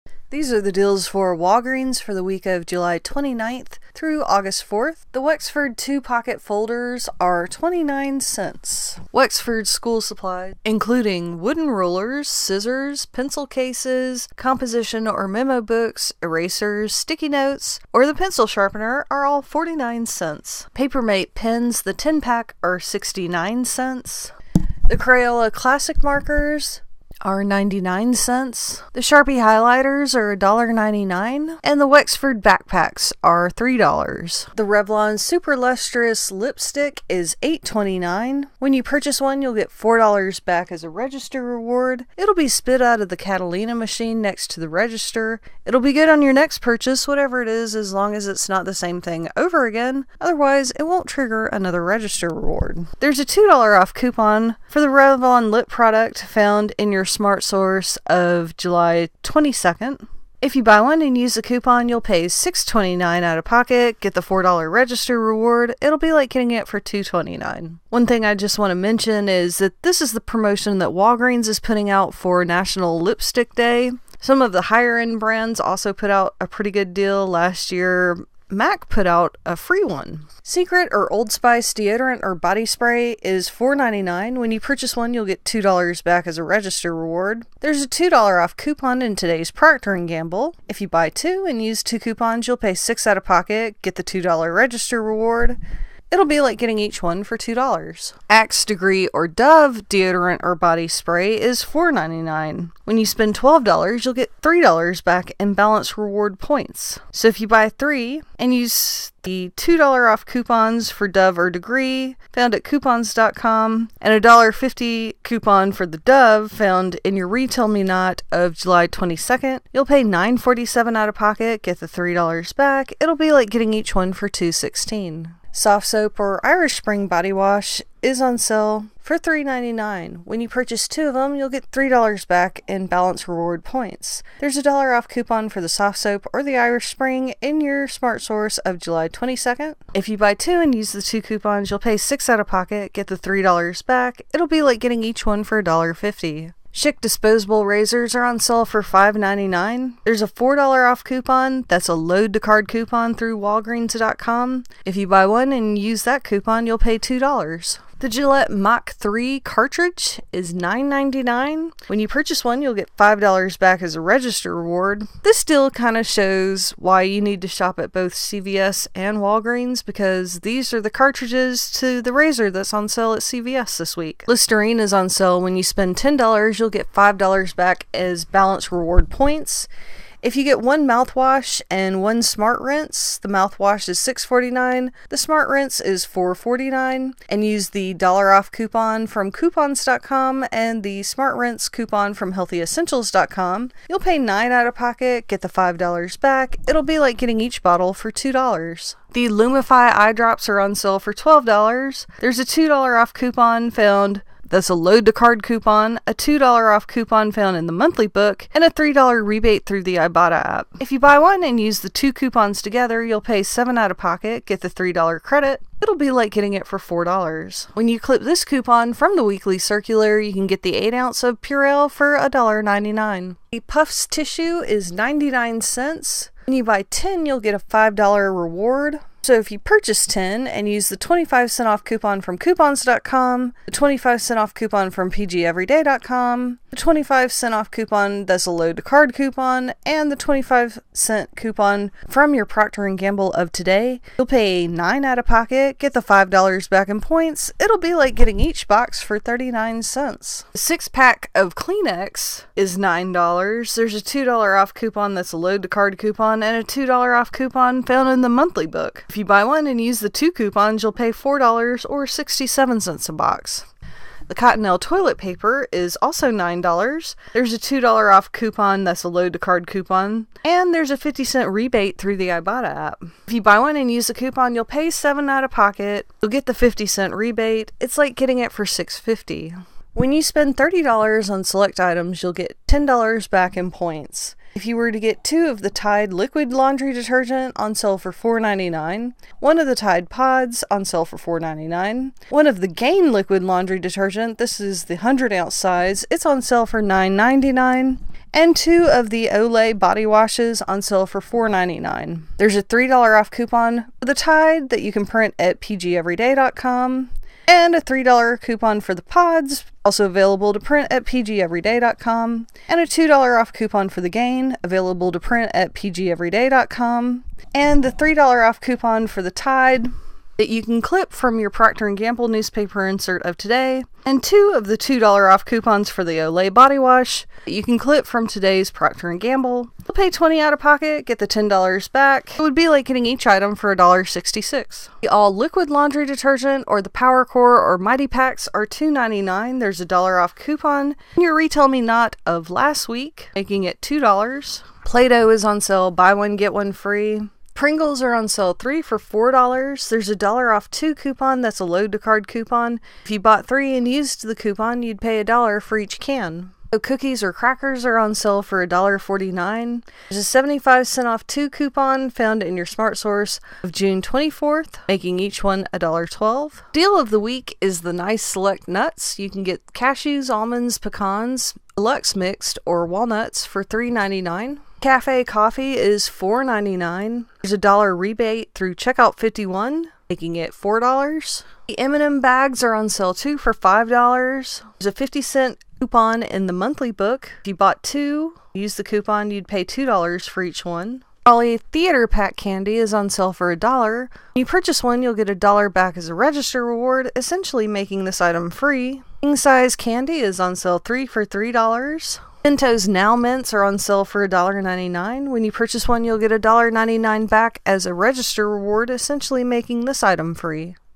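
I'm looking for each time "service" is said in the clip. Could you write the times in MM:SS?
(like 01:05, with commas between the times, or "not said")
not said.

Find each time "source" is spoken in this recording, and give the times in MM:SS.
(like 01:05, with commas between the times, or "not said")
00:57, 02:18, 06:02.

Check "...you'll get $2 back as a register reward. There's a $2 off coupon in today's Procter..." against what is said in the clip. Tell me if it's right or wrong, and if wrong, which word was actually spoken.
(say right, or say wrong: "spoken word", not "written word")
right.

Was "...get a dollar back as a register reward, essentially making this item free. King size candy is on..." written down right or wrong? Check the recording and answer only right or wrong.
right.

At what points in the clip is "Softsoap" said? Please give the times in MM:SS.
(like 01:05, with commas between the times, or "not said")
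02:05, 02:15.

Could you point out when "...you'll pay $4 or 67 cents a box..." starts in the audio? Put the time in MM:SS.
04:20.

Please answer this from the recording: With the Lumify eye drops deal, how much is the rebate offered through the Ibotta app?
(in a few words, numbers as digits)
$3.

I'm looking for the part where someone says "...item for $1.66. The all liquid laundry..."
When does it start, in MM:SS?
05:33.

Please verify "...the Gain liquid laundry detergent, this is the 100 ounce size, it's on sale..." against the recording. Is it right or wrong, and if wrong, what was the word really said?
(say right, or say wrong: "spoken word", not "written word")
right.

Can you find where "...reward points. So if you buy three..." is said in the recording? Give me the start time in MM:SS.
01:45.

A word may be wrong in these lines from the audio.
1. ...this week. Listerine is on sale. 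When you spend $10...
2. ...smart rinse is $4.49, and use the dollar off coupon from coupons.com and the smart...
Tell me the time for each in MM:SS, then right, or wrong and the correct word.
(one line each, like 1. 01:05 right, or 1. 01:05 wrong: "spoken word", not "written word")
1. 02:53 right
2. 03:05 right.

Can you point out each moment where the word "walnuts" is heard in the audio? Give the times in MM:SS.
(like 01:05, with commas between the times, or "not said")
06:12.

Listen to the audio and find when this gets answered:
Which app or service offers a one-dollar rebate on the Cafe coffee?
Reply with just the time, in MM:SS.
06:18.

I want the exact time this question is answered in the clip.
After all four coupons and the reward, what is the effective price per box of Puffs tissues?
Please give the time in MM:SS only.
04:09.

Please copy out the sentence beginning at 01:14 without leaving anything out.
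Some of the higher end brands also put out a pretty good deal last year.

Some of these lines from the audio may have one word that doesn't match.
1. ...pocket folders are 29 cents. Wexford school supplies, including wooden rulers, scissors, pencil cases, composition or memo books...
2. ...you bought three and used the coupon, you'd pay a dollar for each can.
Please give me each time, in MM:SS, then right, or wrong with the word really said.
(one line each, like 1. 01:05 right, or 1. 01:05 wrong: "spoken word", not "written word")
1. 00:05 right
2. 05:53 right.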